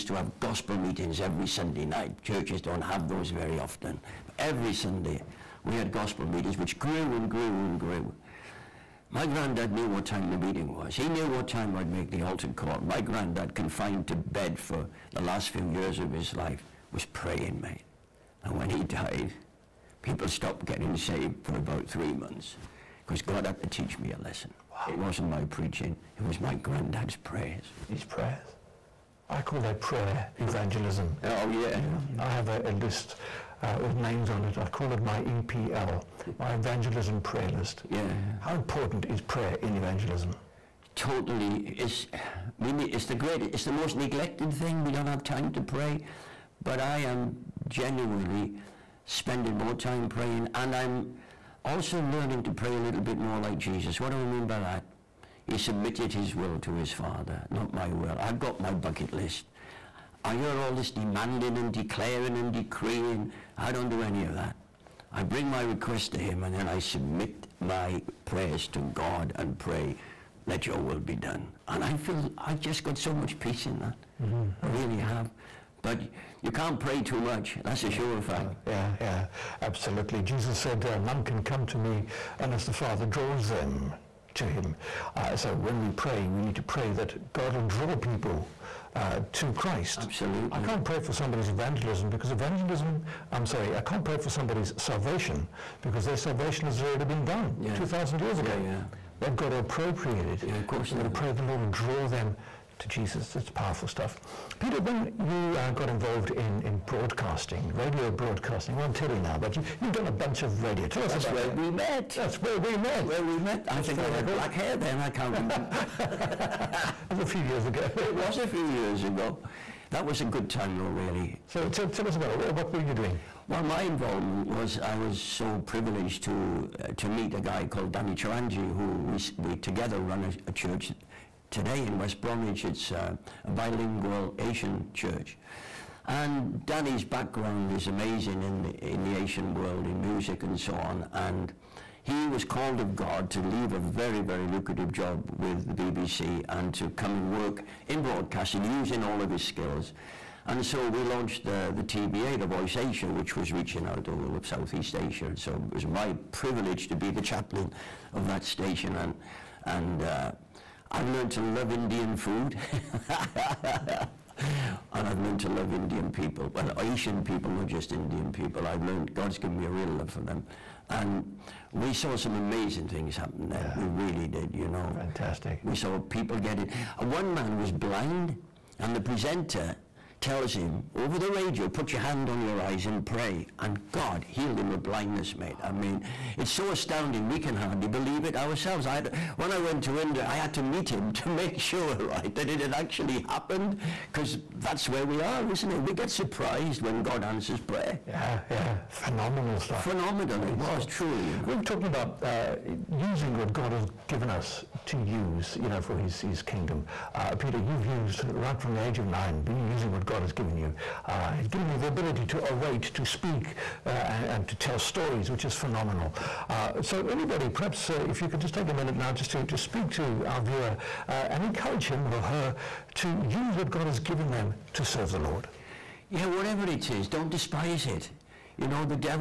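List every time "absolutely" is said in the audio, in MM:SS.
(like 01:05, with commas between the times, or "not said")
01:19, 01:30.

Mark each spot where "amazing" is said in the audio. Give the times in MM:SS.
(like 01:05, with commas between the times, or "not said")
02:17, 02:52.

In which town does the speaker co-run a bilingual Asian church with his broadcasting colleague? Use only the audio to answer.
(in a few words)
West Bromwich.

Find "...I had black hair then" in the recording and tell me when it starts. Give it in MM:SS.
01:53.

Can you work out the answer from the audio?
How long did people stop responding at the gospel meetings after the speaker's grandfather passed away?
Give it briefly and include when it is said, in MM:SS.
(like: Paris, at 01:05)
about 3 months, at 00:21.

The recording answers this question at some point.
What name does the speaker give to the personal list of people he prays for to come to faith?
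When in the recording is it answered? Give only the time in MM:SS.
00:35.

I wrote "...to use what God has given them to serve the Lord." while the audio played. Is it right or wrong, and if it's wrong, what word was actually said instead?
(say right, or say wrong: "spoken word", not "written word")
right.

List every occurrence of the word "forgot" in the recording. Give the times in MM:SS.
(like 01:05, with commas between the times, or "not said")
not said.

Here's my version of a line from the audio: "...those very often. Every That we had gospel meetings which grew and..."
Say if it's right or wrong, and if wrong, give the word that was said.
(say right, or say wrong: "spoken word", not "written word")
wrong: "Sunday", not "That".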